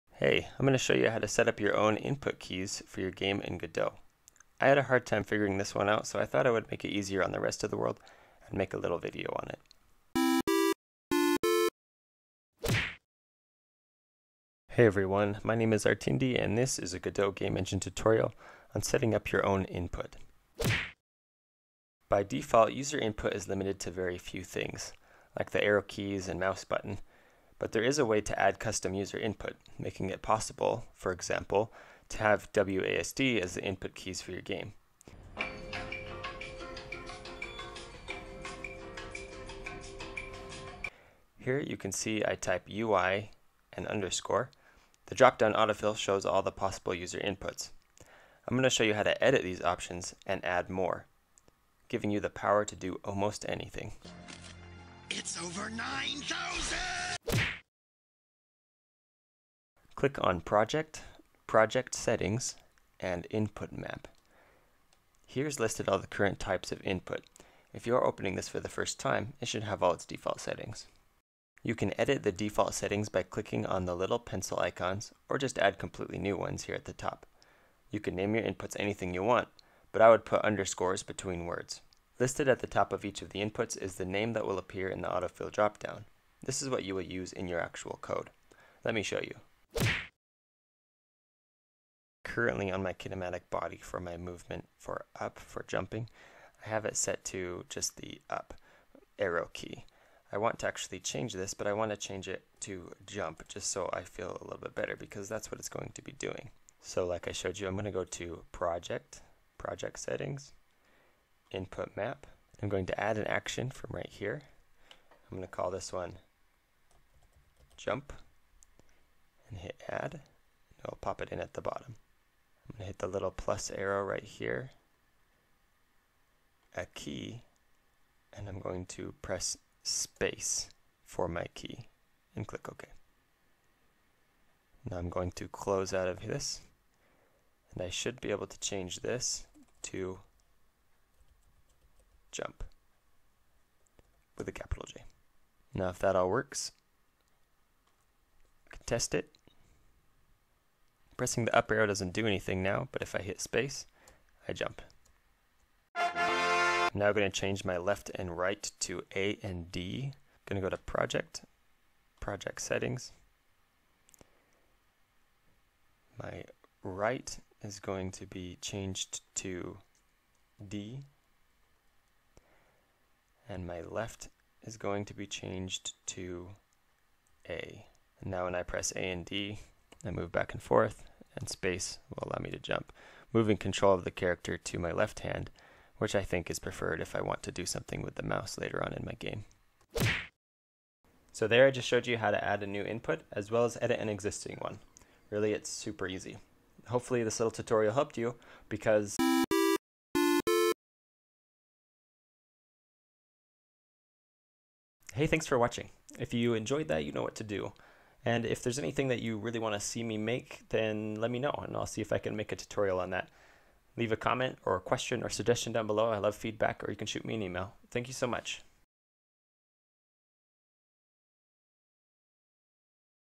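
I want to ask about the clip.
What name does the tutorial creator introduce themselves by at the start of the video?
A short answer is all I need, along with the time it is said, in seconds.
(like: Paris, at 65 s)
Artindi, at 15 s.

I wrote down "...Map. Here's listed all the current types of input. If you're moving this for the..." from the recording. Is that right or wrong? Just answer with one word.
wrong.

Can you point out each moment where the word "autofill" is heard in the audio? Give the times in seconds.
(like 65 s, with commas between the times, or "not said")
45 s, 85 s.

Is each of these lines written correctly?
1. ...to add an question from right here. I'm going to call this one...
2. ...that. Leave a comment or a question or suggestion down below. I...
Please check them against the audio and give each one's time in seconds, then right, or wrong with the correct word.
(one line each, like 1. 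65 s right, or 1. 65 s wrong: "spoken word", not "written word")
1. 112 s wrong: "action", not "question"
2. 213 s right.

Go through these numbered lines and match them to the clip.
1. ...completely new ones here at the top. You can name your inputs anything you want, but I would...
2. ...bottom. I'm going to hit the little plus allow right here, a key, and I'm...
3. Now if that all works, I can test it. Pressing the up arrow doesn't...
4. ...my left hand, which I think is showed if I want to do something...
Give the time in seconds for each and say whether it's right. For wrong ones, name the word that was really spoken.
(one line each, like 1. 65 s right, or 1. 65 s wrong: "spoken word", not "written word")
1. 75 s right
2. 121 s wrong: "arrow", not "allow"
3. 145 s right
4. 184 s wrong: "preferred", not "showed".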